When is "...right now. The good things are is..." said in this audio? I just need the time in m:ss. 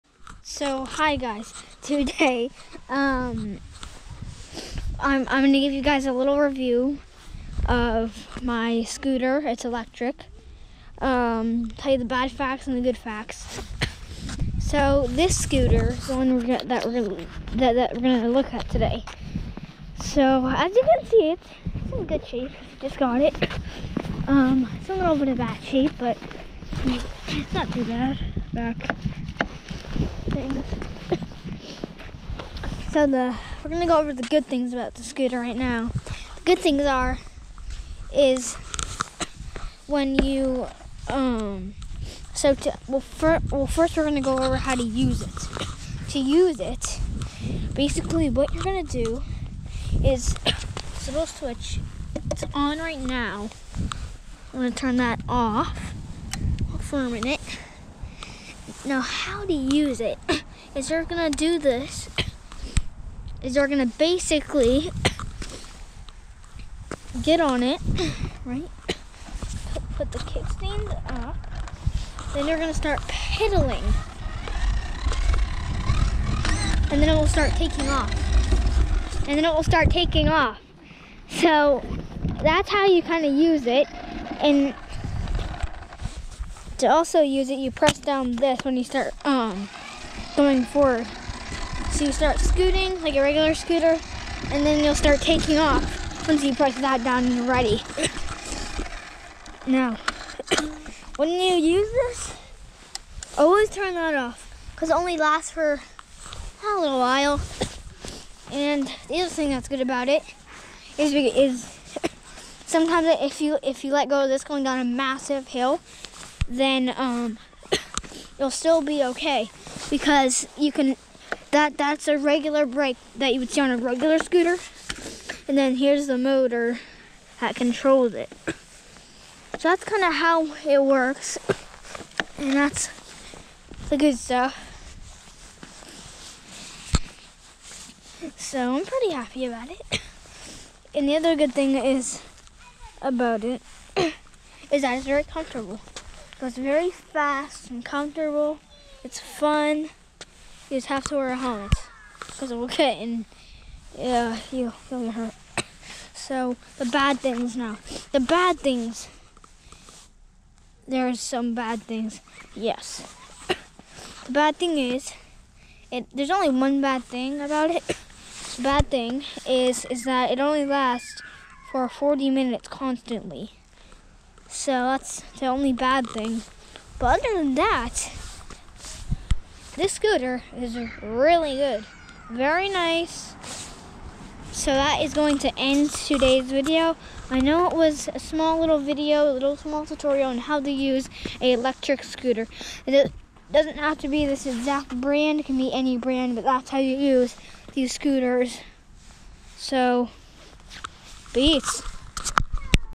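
0:35.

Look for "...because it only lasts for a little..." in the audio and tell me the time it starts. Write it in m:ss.
1:44.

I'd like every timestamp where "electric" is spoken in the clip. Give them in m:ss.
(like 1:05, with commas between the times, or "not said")
0:09, 3:11.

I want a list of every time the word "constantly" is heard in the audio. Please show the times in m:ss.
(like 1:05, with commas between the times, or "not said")
2:52.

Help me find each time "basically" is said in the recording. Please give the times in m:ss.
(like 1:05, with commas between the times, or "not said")
0:47, 1:03.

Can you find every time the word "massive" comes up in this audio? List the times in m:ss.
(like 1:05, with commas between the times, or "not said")
1:54.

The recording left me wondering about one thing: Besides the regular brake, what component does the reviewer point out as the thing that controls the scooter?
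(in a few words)
motor.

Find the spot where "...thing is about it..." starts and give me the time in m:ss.
2:21.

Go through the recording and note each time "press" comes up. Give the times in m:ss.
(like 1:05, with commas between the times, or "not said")
1:27, 1:36.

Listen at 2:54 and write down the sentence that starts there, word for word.
So that's the only bad thing.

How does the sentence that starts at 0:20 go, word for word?
So as you can see, it's, in good shape.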